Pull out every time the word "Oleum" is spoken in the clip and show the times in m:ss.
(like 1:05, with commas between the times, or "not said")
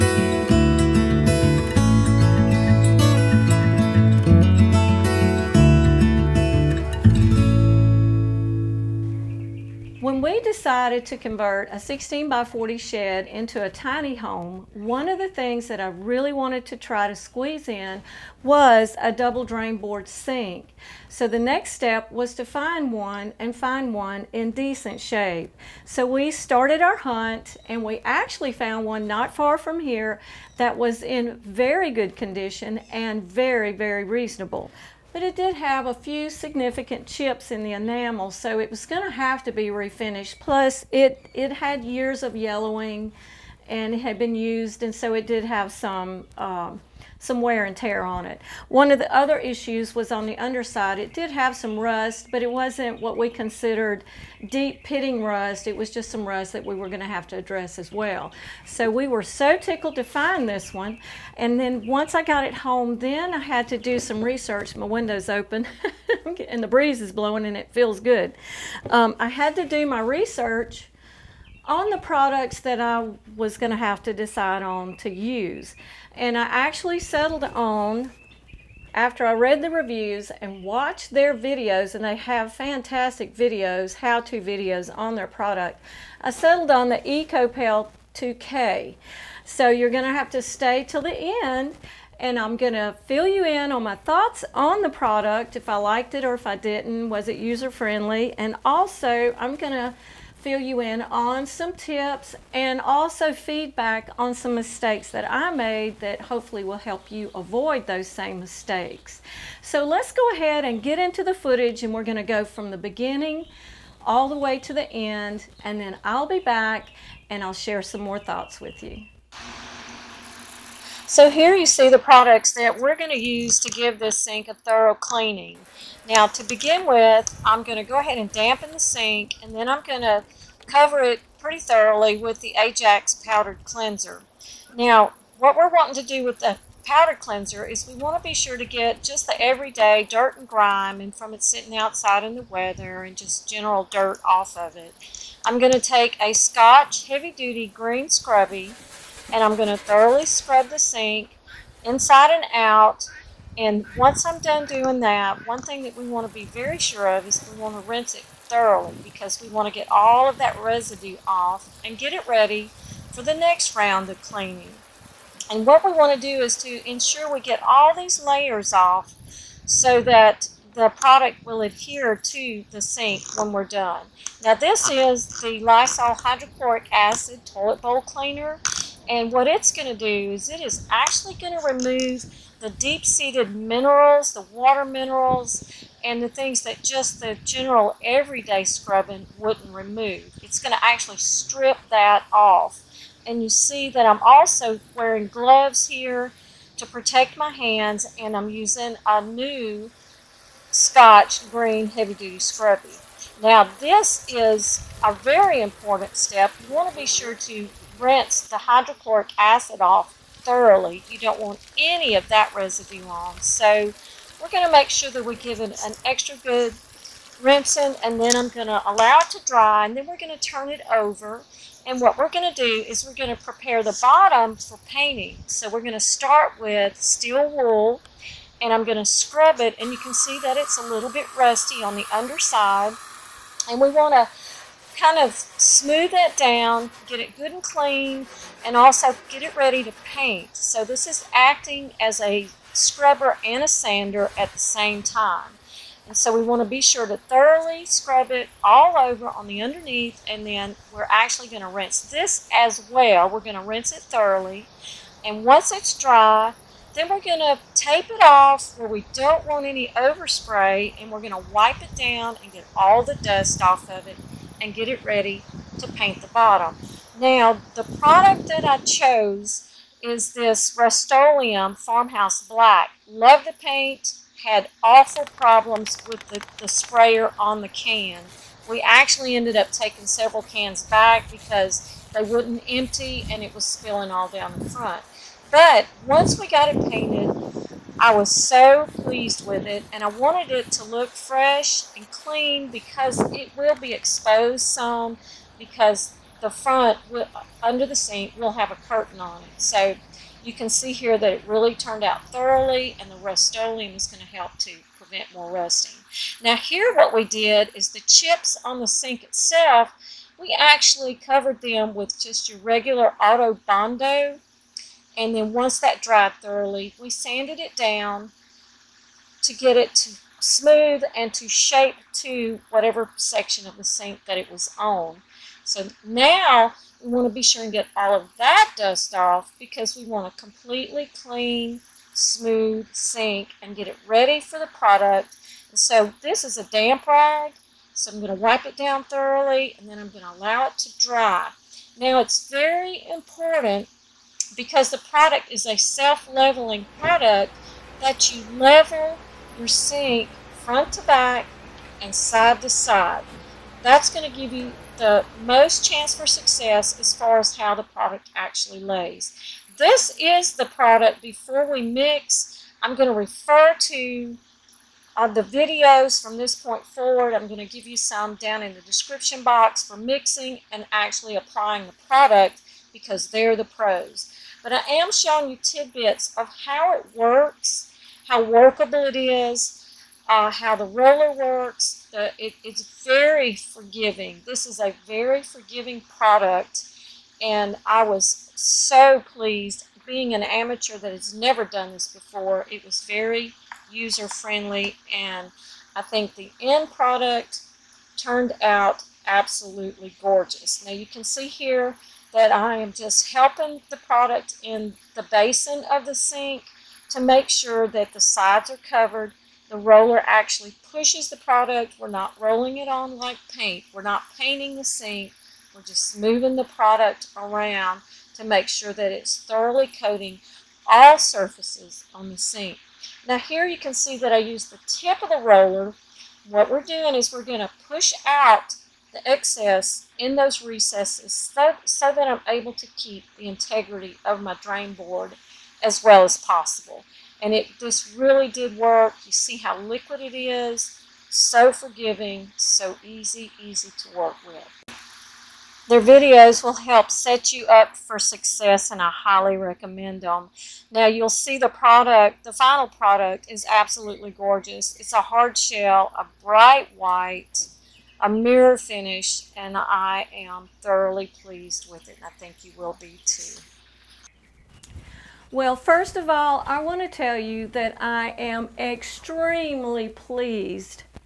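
4:30, 5:03.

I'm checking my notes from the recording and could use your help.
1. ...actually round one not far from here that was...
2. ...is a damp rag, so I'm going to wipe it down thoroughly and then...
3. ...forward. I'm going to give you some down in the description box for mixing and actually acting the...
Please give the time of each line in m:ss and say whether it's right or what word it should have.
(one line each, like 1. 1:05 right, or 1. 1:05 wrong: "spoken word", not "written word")
1. 0:28 wrong: "found", not "round"
2. 5:36 right
3. 6:06 wrong: "applying", not "acting".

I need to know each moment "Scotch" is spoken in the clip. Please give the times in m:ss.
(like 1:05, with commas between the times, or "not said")
2:26, 3:20.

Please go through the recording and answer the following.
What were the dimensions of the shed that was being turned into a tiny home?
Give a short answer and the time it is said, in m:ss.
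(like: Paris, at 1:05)
16 by 40, at 0:11.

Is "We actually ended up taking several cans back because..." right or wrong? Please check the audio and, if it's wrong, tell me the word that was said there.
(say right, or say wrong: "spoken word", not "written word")
right.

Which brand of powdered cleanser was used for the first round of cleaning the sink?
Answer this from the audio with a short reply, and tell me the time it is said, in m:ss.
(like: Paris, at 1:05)
Ajax, at 2:12.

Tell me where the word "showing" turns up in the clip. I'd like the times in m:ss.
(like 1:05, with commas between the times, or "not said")
6:15.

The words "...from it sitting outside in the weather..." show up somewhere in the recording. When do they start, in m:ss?
2:21.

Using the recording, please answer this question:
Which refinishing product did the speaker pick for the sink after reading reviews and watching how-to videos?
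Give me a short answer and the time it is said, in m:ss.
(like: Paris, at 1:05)
Ekopel 2K, at 1:26.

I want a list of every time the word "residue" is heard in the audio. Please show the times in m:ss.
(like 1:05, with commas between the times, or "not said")
2:40, 3:32.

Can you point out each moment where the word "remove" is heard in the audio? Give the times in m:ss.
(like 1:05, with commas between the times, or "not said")
3:01, 3:09.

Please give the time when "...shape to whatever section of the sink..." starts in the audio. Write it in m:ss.
5:21.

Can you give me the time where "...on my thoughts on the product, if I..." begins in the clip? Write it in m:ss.
1:33.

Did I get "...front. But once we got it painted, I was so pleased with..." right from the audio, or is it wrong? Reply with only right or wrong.
right.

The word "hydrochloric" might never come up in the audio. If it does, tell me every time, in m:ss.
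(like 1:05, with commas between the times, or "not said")
2:56, 3:28.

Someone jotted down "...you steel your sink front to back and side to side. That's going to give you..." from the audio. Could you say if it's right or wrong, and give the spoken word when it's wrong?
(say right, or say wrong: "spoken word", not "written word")
wrong: "level", not "steel".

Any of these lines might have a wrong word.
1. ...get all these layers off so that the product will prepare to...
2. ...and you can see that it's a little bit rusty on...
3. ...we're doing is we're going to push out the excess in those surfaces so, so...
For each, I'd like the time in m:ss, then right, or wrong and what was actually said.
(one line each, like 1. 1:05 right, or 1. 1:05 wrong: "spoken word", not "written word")
1. 2:47 wrong: "adhere", not "prepare"
2. 3:49 right
3. 7:06 wrong: "recesses", not "surfaces".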